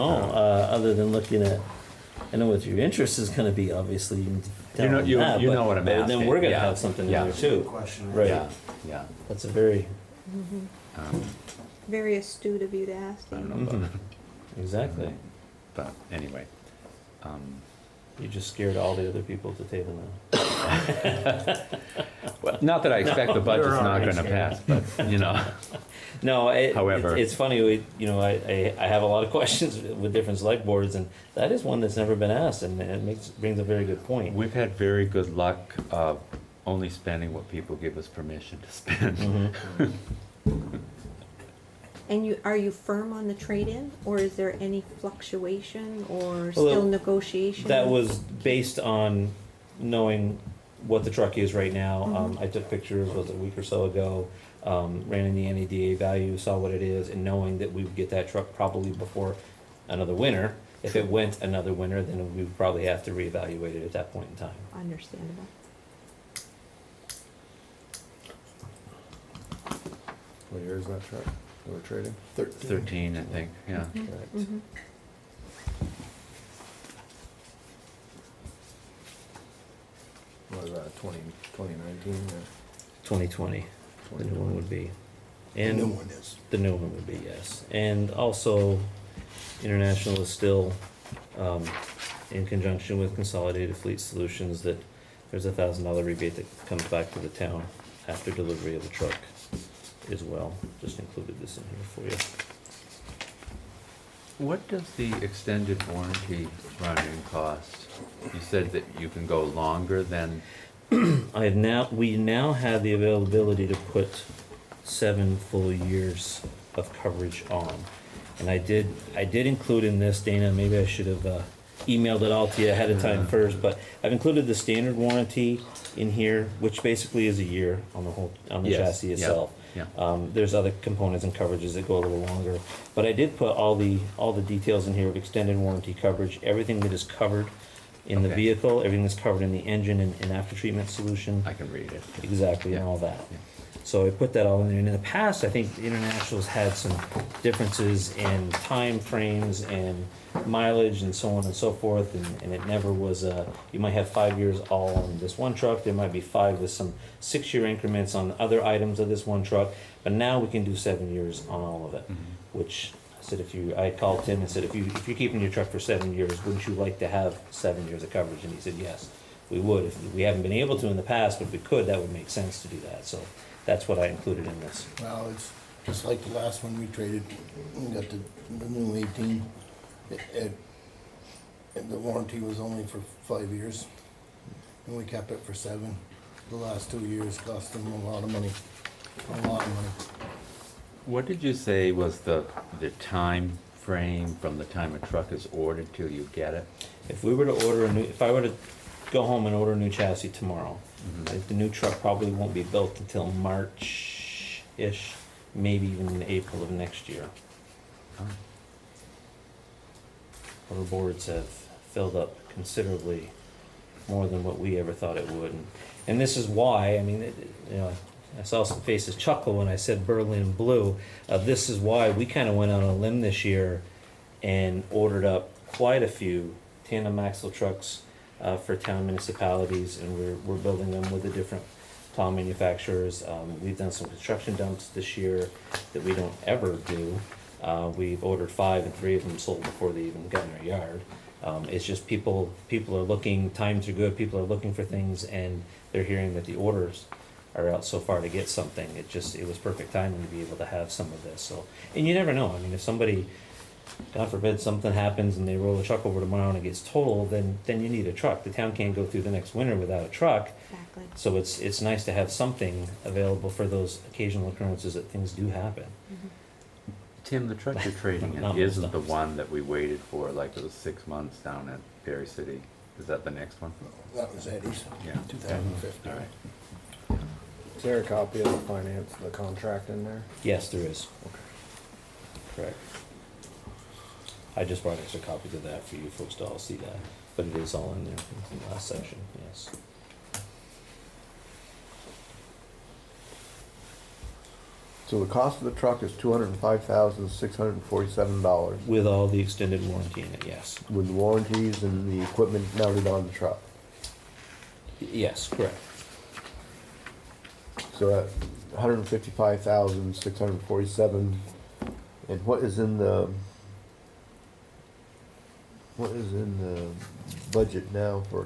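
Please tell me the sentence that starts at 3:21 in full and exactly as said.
The new truck probably won't be built until March-ish, maybe even April of next year.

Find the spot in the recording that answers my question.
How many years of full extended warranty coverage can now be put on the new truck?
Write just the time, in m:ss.
1:54.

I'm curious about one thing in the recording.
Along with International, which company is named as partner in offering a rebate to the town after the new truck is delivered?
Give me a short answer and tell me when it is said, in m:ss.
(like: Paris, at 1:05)
Consolidated Fleet Solutions, at 1:33.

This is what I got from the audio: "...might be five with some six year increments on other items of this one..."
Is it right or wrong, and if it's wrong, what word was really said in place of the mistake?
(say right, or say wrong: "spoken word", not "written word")
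right.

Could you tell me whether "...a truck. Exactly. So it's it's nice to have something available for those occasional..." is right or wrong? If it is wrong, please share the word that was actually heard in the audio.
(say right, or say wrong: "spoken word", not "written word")
right.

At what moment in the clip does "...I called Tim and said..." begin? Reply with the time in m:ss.
2:43.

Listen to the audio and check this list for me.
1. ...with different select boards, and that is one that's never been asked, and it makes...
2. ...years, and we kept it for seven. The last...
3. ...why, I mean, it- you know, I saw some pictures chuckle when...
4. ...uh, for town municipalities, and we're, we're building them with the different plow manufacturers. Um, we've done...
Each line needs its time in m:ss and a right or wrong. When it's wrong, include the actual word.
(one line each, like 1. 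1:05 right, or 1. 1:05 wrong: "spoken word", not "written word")
1. 0:29 right
2. 3:03 right
3. 3:36 wrong: "faces", not "pictures"
4. 3:48 right.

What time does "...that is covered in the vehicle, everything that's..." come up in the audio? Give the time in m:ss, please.
2:16.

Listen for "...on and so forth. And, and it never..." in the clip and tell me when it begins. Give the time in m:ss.
2:31.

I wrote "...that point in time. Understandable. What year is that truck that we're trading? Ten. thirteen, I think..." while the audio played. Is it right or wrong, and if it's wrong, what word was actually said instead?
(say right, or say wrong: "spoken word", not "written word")
wrong: "Thirteen", not "Ten".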